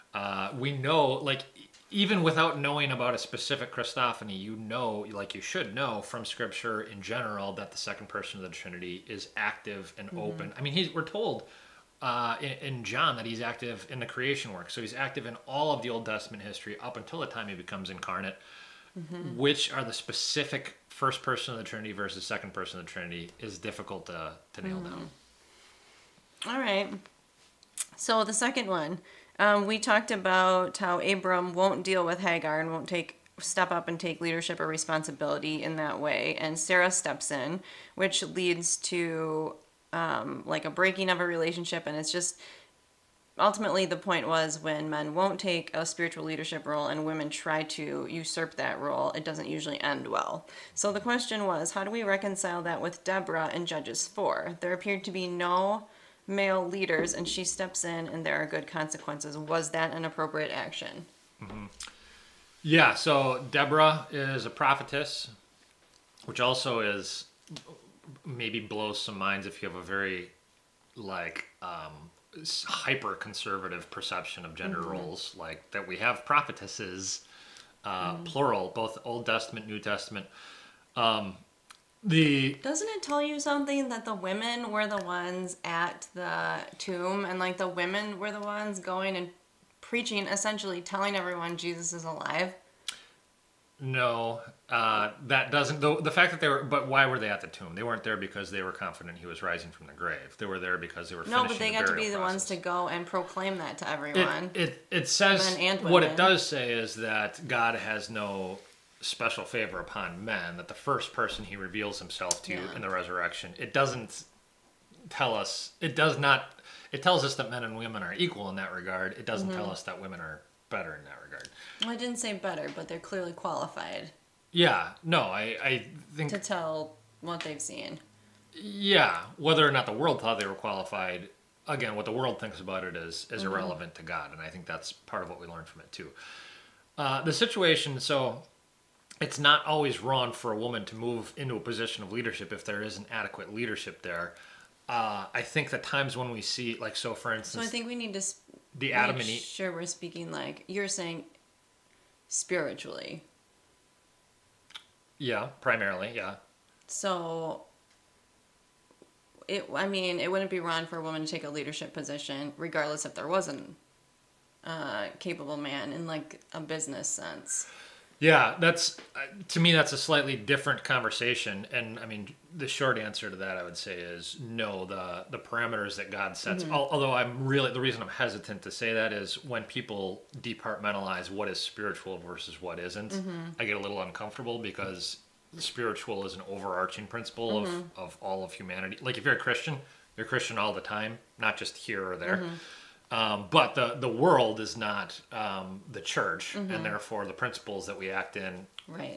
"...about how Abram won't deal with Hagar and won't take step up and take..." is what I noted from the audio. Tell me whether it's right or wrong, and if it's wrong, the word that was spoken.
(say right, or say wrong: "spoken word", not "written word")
right.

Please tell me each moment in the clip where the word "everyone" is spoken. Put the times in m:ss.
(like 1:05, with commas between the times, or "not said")
1:31, 1:43.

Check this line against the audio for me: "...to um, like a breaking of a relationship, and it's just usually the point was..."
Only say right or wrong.
wrong.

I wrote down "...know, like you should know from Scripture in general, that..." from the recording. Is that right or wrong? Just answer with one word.
right.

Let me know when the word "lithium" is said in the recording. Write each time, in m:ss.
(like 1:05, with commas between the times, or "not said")
not said.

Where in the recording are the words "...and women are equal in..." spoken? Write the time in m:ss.
1:57.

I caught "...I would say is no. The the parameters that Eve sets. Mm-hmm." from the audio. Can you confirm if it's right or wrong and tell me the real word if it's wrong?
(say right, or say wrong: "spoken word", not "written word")
wrong: "God", not "Eve".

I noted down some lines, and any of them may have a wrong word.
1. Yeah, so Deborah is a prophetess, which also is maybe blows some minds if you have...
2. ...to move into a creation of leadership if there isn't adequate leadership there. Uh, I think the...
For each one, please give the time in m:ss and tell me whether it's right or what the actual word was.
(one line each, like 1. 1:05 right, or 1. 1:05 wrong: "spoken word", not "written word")
1. 1:02 right
2. 2:20 wrong: "position", not "creation".